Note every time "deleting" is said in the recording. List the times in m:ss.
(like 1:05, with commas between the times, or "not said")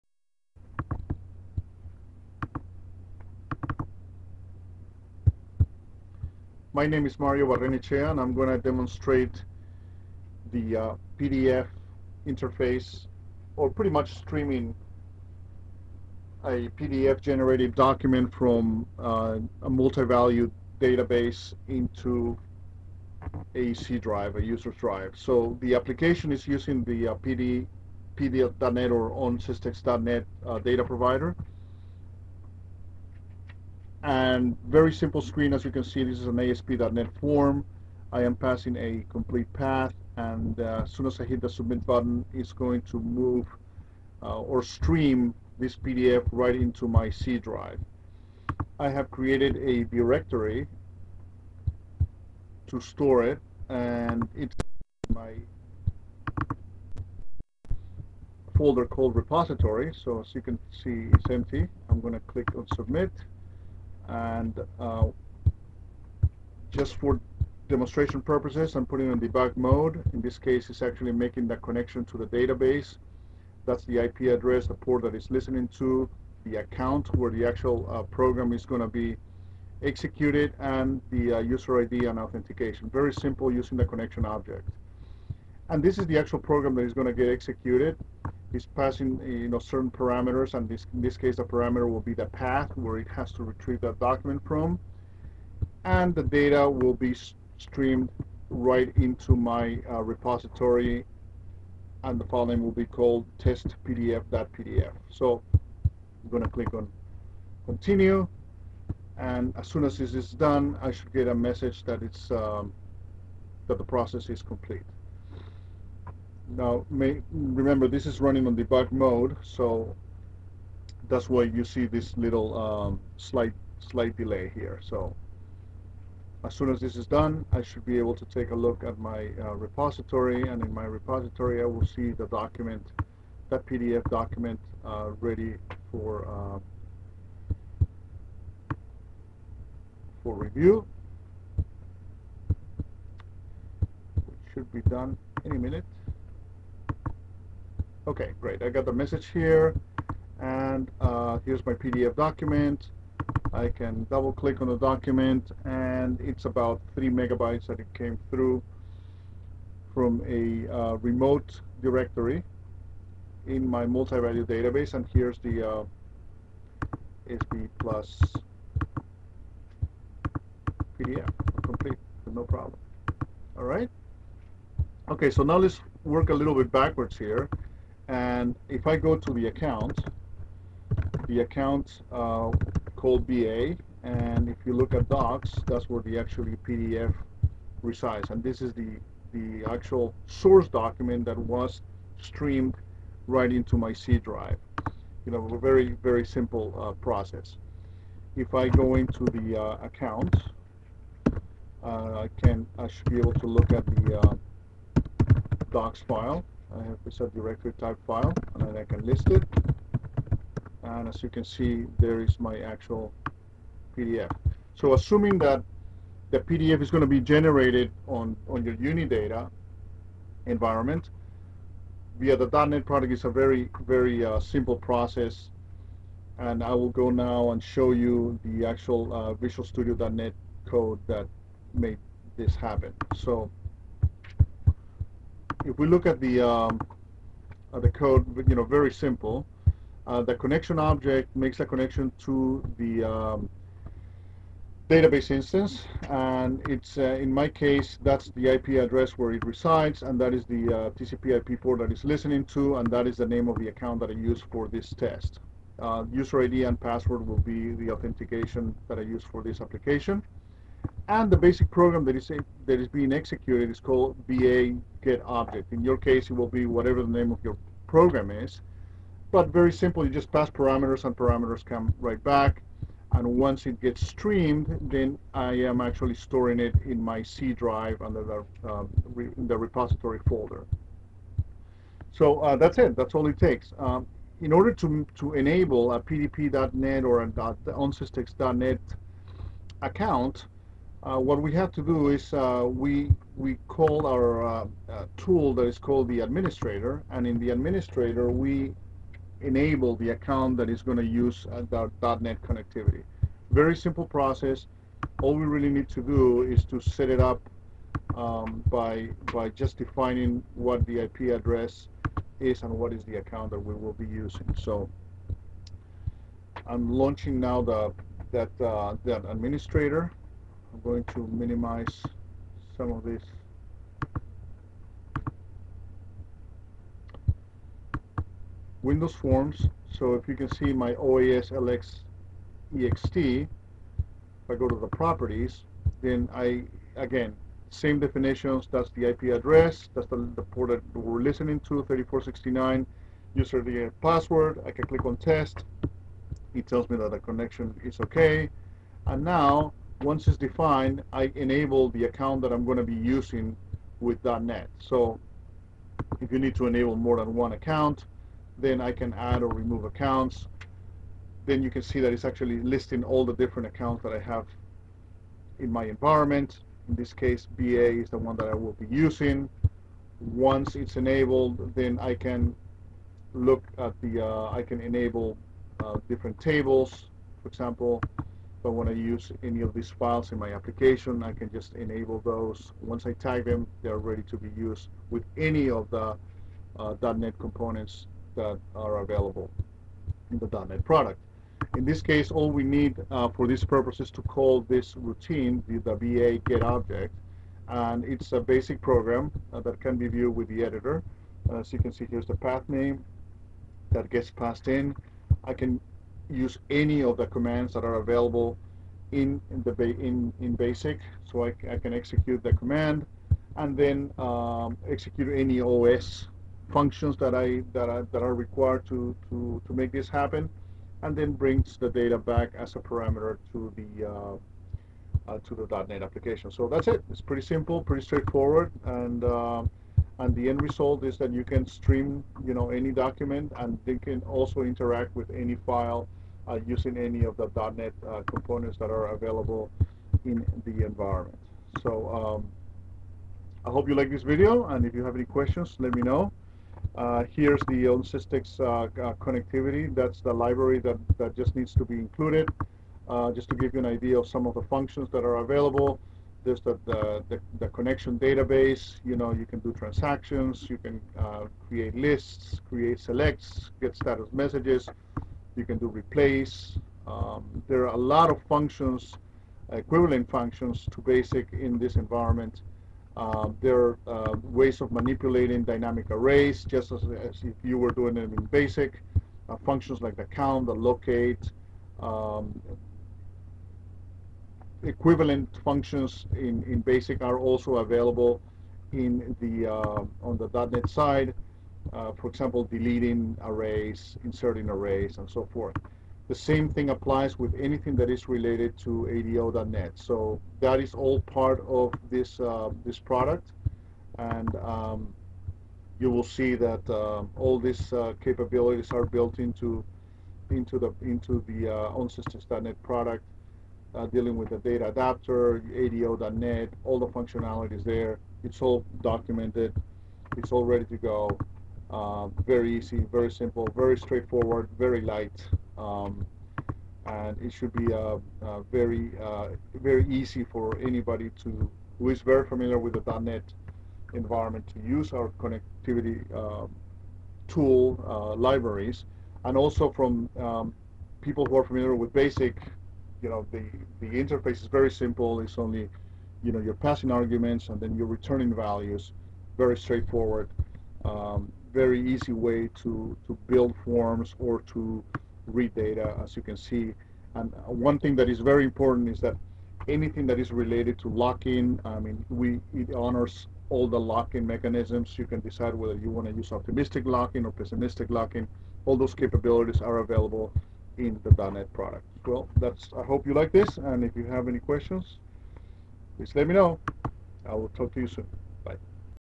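8:12.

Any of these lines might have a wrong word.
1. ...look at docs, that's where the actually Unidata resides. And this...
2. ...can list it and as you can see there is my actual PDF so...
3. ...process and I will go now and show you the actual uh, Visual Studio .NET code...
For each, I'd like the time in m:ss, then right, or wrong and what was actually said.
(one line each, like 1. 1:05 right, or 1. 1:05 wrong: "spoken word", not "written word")
1. 3:04 wrong: "PDF", not "Unidata"
2. 3:28 right
3. 3:44 right.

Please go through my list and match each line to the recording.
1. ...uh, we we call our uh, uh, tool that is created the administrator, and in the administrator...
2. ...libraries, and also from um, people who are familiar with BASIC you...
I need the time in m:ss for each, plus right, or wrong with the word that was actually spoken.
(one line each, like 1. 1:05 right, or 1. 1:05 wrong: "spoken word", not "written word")
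1. 4:52 wrong: "called", not "created"
2. 8:58 right.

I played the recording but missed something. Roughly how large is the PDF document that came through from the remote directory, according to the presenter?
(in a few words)
About 3 megabytes.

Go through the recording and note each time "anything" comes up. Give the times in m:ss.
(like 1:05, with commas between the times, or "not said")
8:17, 9:19.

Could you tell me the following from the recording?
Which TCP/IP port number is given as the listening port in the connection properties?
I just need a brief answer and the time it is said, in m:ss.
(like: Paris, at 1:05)
3469, at 5:41.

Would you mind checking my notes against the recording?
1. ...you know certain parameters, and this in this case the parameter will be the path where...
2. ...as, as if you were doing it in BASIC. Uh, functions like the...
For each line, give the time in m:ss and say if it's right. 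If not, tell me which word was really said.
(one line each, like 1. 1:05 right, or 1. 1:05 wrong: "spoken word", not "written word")
1. 1:29 right
2. 7:56 right.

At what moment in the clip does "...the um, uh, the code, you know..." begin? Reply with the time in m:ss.
3:56.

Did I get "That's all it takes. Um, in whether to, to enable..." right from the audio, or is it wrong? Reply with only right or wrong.
wrong.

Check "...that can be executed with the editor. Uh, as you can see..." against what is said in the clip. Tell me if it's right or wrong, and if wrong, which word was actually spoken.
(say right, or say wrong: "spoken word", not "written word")
wrong: "viewed", not "executed".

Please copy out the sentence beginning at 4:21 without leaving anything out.
And the basic program that is, that is being executed is called BA get object.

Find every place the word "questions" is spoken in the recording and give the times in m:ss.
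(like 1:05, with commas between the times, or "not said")
7:25, 9:34.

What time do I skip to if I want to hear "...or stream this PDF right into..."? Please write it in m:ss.
0:44.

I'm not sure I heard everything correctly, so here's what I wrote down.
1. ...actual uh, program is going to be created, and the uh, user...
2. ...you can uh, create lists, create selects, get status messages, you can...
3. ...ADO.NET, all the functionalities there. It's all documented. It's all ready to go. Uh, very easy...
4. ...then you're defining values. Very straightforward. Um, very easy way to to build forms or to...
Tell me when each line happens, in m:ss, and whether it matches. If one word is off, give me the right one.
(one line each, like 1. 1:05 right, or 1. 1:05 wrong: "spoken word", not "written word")
1. 1:17 wrong: "executed", not "created"
2. 7:40 right
3. 8:35 right
4. 9:07 wrong: "returning", not "defining".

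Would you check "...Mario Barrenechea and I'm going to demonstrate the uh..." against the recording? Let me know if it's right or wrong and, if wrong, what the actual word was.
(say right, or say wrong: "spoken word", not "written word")
right.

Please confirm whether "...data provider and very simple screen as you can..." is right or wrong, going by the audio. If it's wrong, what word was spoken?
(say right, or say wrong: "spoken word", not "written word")
right.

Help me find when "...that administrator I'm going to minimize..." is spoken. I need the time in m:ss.
5:19.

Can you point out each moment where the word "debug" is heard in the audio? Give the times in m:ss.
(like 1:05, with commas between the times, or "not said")
1:09, 1:58.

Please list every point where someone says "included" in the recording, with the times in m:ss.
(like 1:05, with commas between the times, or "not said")
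7:31.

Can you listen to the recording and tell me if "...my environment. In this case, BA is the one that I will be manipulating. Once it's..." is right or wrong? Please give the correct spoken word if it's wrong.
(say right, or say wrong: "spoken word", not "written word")
wrong: "using", not "manipulating".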